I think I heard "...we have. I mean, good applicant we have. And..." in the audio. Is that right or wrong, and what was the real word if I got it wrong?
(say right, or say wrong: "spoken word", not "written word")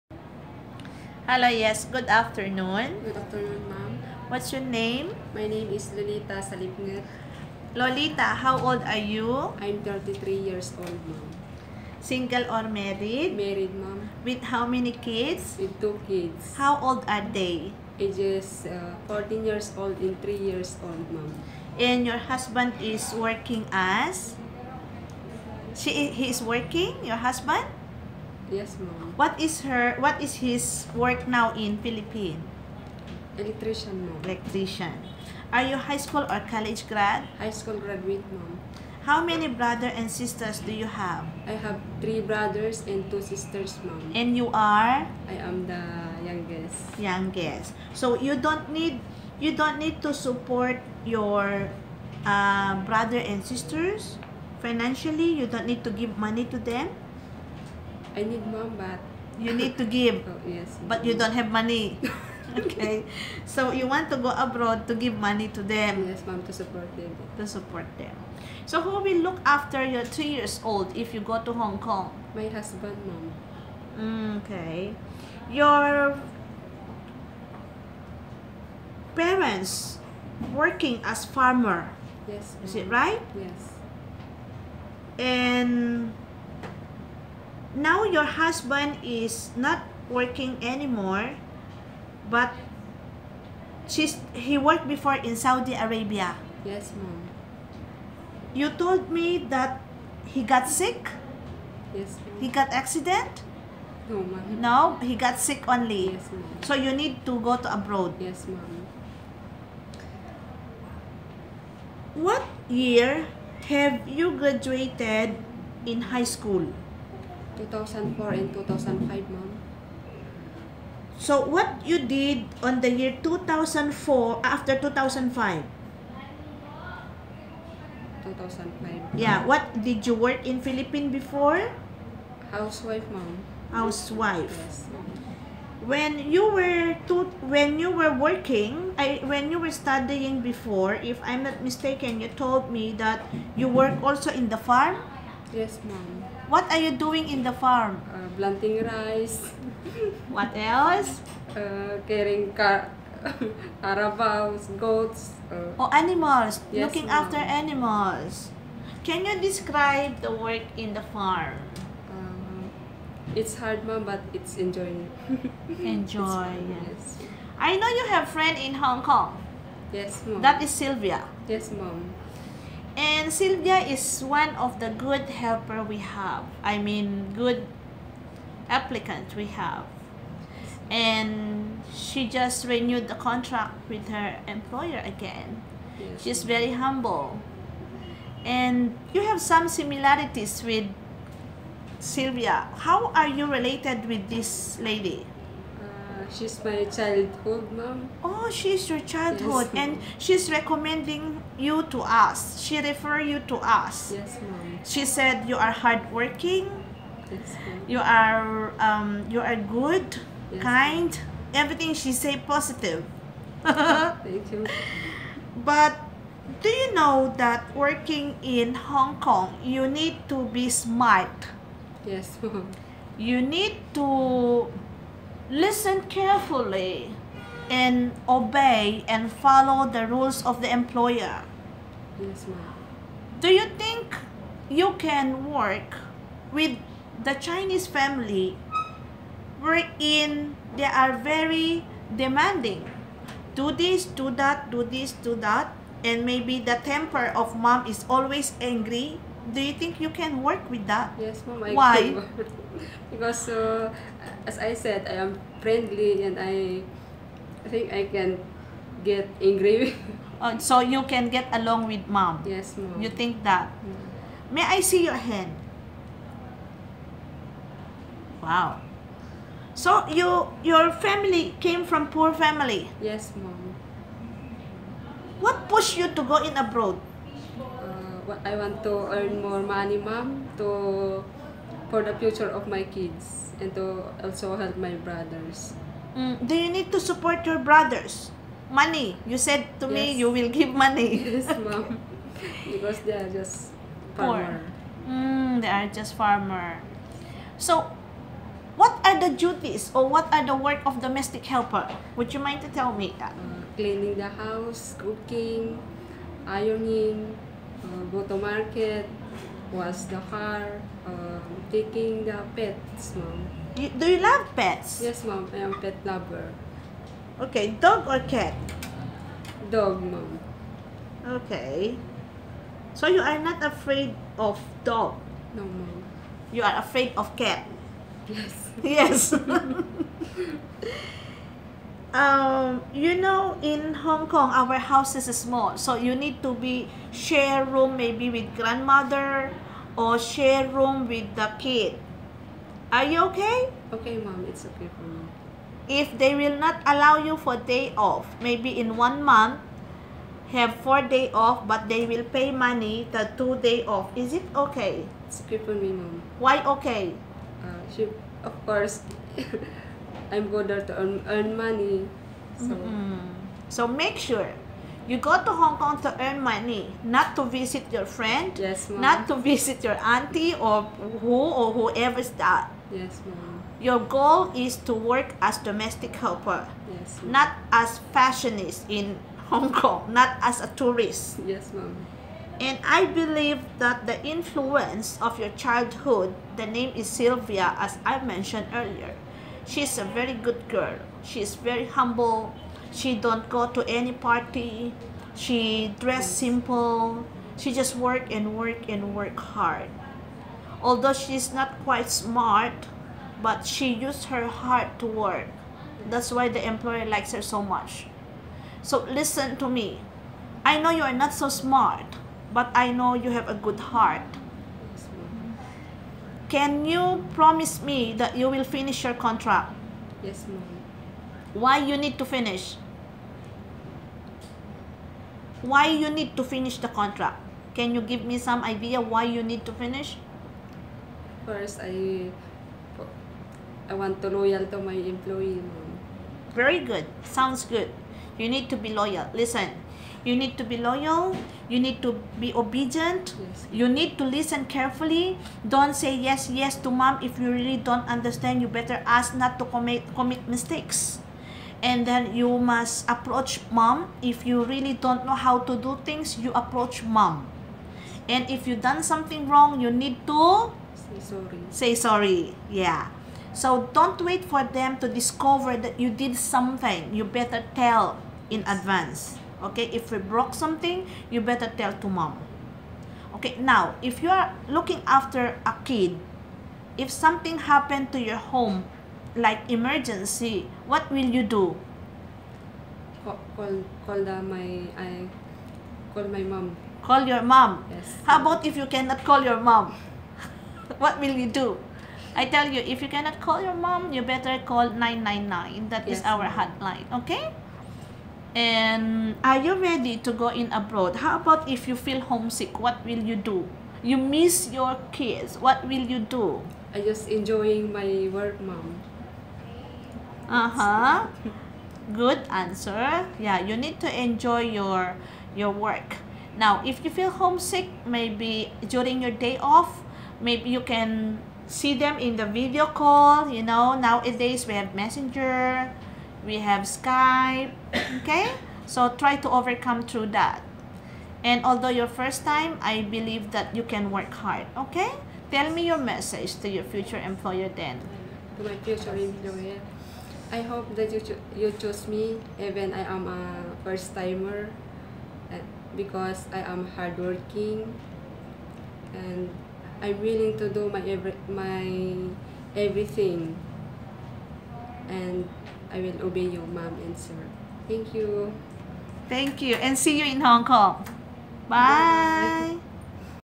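right.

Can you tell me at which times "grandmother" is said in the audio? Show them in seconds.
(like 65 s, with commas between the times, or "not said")
338 s.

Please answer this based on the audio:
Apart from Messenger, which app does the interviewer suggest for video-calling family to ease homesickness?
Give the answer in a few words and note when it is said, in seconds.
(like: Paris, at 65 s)
Skype, at 526 s.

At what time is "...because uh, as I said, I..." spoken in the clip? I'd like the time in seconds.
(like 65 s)
253 s.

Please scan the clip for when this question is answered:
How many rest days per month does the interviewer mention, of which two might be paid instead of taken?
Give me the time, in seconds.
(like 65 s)
350 s.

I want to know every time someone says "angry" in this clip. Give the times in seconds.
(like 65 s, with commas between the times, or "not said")
248 s, 259 s.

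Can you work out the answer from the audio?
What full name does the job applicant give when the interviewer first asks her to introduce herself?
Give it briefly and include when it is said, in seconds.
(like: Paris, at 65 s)
Lolita Salipngat, at 5 s.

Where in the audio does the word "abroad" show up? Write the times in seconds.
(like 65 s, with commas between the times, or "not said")
64 s, 107 s, 276 s, 500 s.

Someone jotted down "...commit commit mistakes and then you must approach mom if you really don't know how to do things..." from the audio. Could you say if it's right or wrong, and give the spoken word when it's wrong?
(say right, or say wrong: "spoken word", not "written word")
right.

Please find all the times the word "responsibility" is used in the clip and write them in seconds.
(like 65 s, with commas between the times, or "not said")
not said.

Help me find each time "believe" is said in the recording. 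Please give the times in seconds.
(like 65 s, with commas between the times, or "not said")
383 s, 533 s.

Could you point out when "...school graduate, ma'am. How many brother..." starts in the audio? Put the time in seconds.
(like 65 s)
37 s.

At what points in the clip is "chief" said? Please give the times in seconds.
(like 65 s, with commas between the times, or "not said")
not said.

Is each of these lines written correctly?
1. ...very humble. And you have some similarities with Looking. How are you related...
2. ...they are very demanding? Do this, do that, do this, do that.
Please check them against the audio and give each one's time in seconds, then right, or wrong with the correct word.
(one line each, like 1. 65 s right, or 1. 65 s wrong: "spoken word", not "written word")
1. 186 s wrong: "Sylvia", not "Looking"
2. 240 s right.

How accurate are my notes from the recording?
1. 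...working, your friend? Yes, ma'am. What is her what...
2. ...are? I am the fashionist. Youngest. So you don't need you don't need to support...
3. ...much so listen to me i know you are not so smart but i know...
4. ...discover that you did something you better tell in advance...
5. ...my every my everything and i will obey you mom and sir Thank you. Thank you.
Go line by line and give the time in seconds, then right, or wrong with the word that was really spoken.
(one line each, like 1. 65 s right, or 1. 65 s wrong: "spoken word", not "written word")
1. 26 s wrong: "husband", not "friend"
2. 44 s wrong: "youngest", not "fashionist"
3. 407 s right
4. 465 s right
5. 550 s right.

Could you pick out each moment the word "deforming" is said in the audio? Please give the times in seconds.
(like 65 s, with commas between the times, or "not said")
not said.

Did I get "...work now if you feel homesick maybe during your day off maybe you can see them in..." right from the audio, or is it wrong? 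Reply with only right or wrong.
right.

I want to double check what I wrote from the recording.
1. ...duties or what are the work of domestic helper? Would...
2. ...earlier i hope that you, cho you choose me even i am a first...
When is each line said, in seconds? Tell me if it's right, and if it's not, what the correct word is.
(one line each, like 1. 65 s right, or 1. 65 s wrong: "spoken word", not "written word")
1. 299 s right
2. 539 s wrong: "employer", not "earlier".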